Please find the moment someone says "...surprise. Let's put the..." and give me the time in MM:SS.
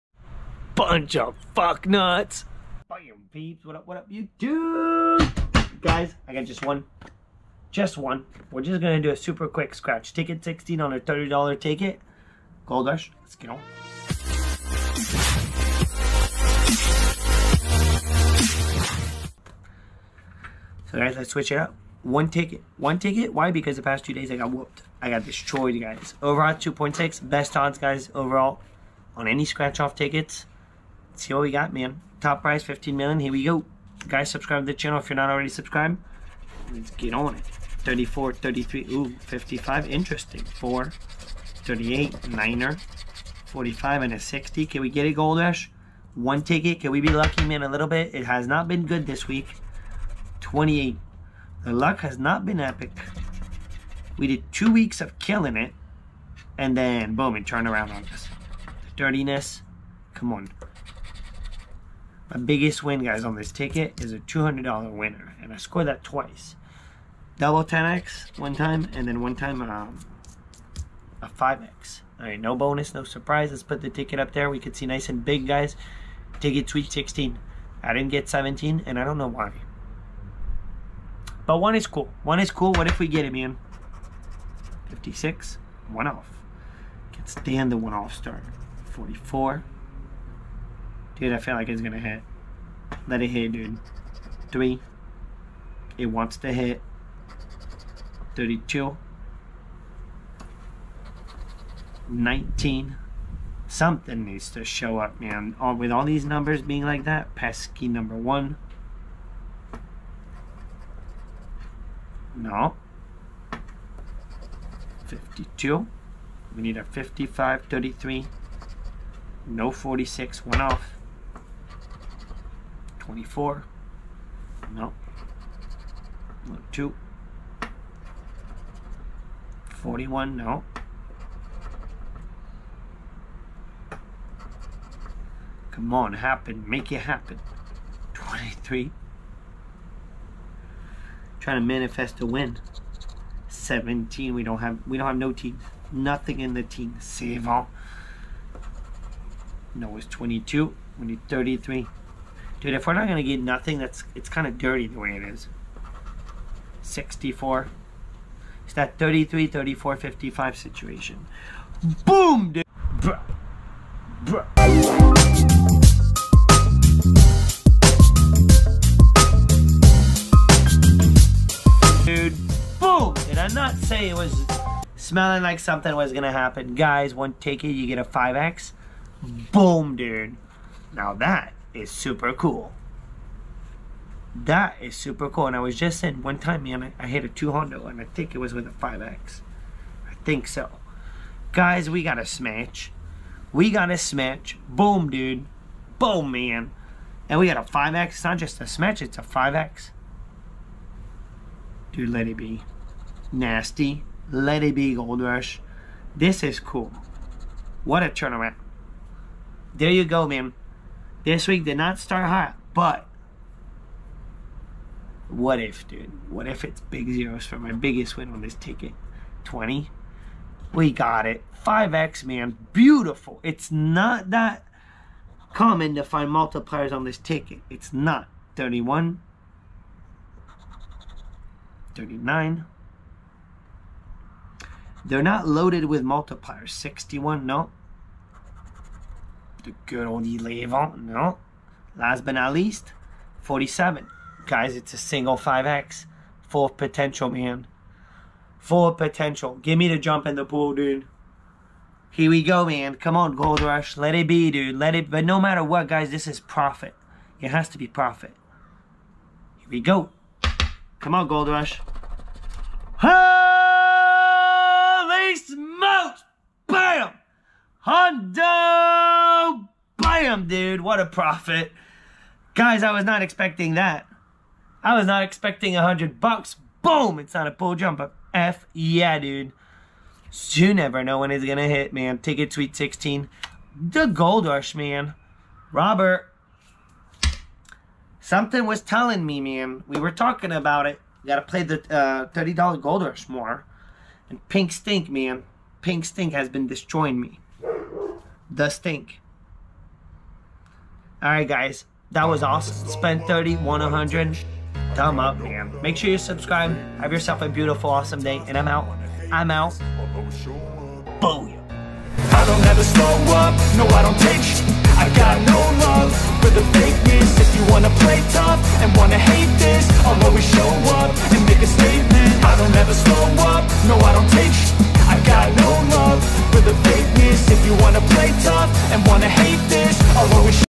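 01:13.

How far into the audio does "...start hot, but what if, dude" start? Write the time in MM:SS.
03:31.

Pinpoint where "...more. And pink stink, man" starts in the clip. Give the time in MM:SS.
04:53.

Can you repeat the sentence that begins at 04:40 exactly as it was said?
So you never know when it's gonna hit, man.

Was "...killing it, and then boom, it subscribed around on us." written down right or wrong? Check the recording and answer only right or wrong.
wrong.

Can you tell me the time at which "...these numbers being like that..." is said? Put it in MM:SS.
01:46.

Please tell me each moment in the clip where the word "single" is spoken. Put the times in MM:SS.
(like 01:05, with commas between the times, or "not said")
04:04.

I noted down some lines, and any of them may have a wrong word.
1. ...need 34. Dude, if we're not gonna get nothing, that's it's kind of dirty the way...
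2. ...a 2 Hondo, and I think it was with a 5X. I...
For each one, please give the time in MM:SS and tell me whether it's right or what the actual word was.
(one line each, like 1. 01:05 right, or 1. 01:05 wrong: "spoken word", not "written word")
1. 02:31 wrong: "33", not "34"
2. 03:07 right.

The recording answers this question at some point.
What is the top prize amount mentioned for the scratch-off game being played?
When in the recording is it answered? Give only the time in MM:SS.
00:32.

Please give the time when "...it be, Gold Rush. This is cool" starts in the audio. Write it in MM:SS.
03:24.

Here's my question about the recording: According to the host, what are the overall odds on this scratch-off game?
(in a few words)
2.6.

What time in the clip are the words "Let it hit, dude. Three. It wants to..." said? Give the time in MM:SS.
01:33.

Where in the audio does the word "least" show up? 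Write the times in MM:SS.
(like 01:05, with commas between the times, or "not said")
04:02.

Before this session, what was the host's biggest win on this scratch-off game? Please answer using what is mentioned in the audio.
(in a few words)
$200.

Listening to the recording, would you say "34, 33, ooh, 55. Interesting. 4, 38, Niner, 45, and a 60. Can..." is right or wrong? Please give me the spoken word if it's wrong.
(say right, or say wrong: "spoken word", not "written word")
right.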